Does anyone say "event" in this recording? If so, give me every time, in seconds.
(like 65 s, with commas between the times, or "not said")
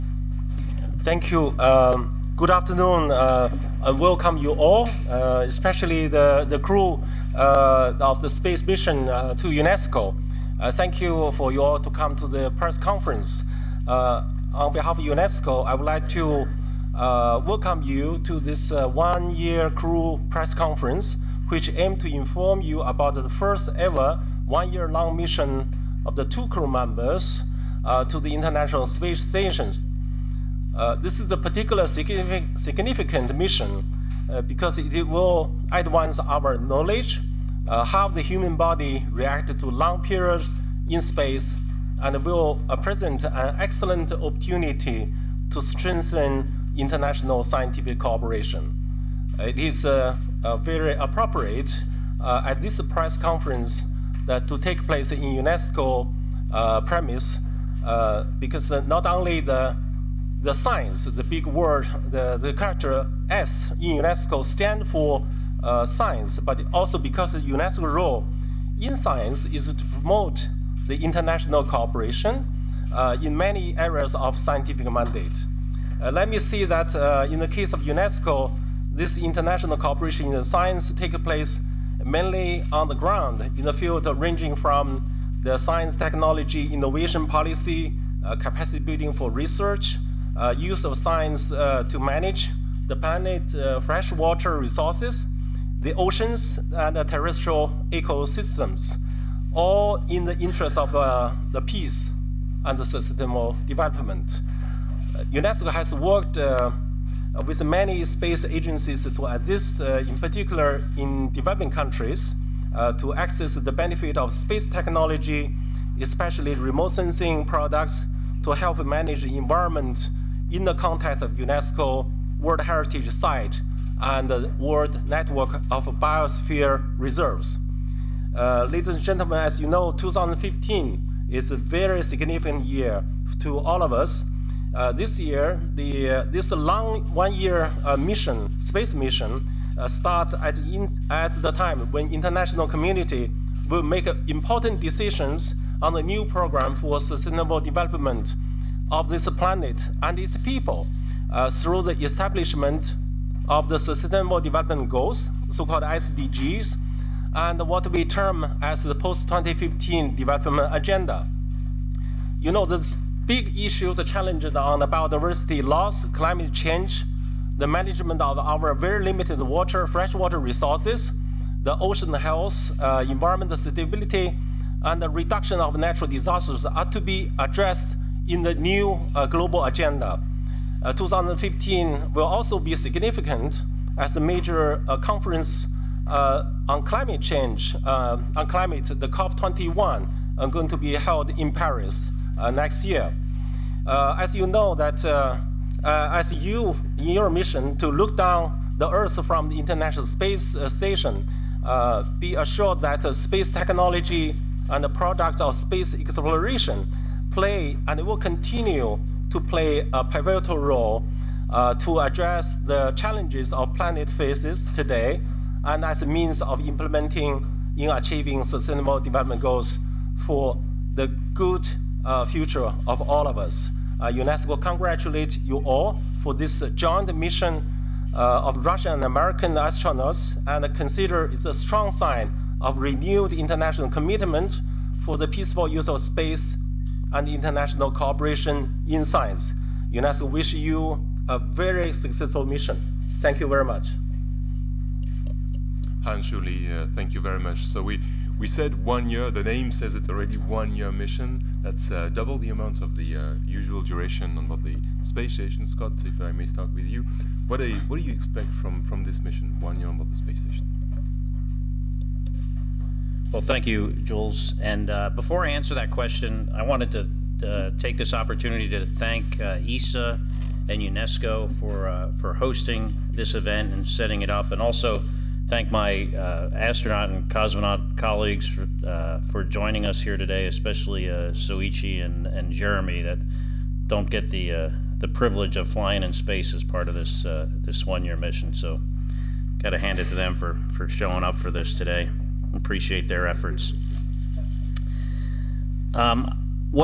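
273 s.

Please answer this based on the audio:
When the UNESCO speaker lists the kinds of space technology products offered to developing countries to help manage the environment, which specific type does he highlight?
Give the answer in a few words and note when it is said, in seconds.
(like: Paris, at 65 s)
remote sensing products, at 116 s.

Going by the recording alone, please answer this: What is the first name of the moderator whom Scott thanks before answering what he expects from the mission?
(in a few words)
Jules.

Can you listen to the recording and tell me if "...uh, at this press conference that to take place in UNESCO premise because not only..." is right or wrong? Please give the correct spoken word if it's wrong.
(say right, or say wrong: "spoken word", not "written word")
right.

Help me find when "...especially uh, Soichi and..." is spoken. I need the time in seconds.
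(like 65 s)
280 s.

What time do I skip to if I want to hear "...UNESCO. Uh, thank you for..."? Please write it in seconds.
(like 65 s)
9 s.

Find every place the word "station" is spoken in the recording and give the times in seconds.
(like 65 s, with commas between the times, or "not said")
29 s, 200 s, 255 s, 260 s.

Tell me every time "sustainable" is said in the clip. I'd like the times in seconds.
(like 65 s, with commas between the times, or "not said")
102 s, 146 s, 153 s, 218 s.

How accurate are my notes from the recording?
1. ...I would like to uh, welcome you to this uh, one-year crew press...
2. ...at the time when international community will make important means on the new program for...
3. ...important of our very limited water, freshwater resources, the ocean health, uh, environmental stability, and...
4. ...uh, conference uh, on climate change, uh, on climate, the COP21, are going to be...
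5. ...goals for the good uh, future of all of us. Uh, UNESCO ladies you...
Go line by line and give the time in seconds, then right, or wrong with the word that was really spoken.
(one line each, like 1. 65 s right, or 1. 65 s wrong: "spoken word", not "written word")
1. 15 s right
2. 141 s wrong: "decisions", not "means"
3. 167 s wrong: "management", not "important"
4. 184 s right
5. 219 s wrong: "congratulates", not "ladies".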